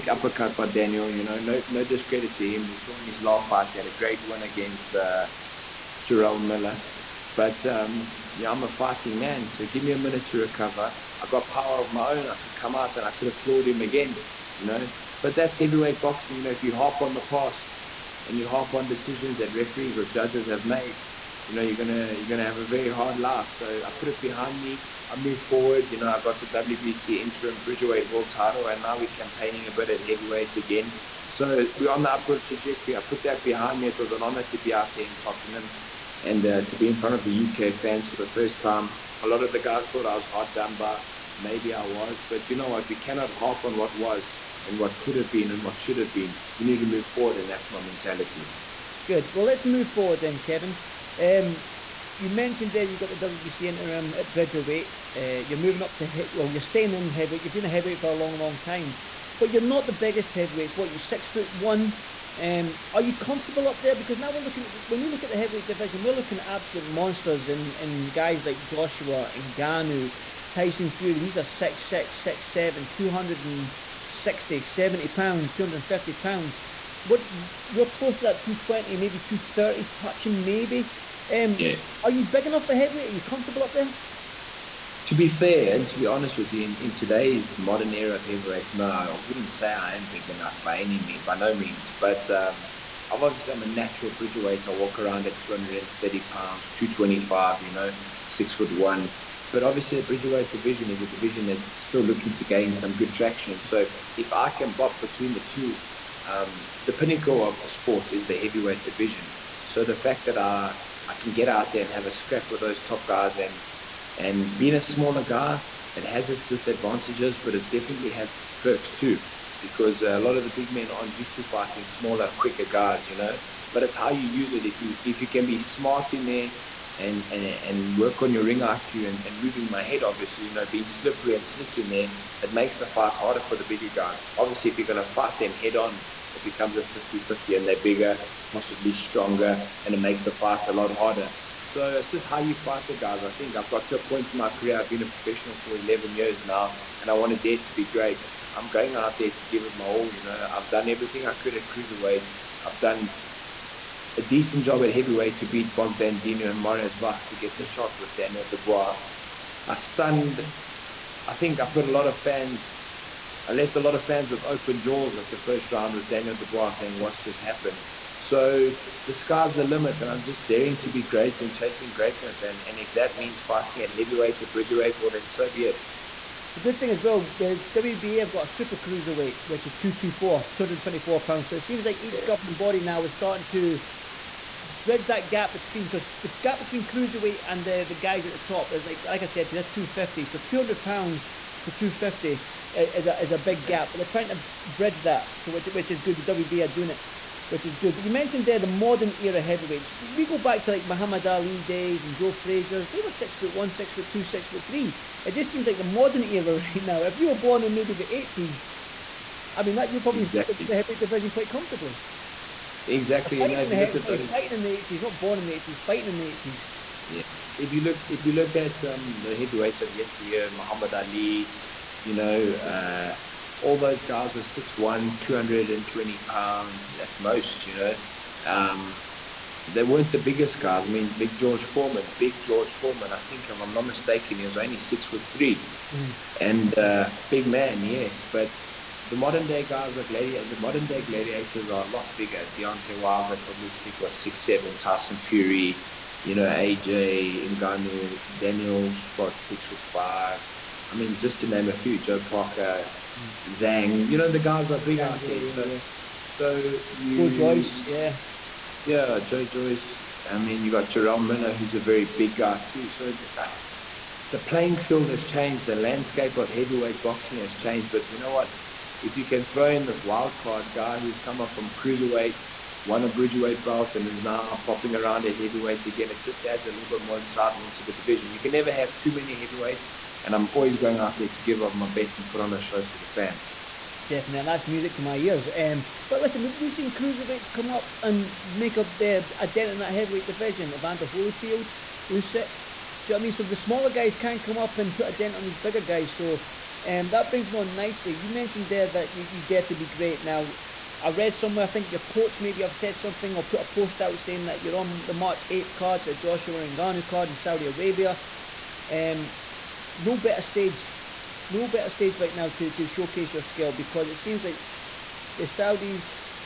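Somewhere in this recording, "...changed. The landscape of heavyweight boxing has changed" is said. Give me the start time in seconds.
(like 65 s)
265 s.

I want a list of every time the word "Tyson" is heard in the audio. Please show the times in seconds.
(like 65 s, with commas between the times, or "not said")
70 s, 244 s.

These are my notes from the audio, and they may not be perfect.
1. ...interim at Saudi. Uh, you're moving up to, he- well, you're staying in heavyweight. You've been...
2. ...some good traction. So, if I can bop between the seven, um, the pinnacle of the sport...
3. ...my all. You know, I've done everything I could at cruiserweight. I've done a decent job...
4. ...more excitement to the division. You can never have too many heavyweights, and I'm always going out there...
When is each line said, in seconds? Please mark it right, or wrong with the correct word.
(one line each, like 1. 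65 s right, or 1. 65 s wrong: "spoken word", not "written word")
1. 53 s wrong: "Bridgerweight", not "Saudi"
2. 102 s wrong: "two", not "seven"
3. 149 s right
4. 277 s right.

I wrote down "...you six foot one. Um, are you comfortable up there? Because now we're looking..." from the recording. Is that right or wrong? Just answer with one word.
right.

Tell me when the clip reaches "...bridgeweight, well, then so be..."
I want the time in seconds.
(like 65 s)
174 s.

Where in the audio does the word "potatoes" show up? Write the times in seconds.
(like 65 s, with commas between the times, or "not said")
not said.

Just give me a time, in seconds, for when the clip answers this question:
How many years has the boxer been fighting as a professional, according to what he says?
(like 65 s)
145 s.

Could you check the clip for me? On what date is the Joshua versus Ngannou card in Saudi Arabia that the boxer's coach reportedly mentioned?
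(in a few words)
March 8th.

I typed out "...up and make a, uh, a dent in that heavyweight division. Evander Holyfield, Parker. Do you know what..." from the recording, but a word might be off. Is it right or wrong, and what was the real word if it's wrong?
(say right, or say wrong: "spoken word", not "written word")
wrong: "Usyk", not "Parker".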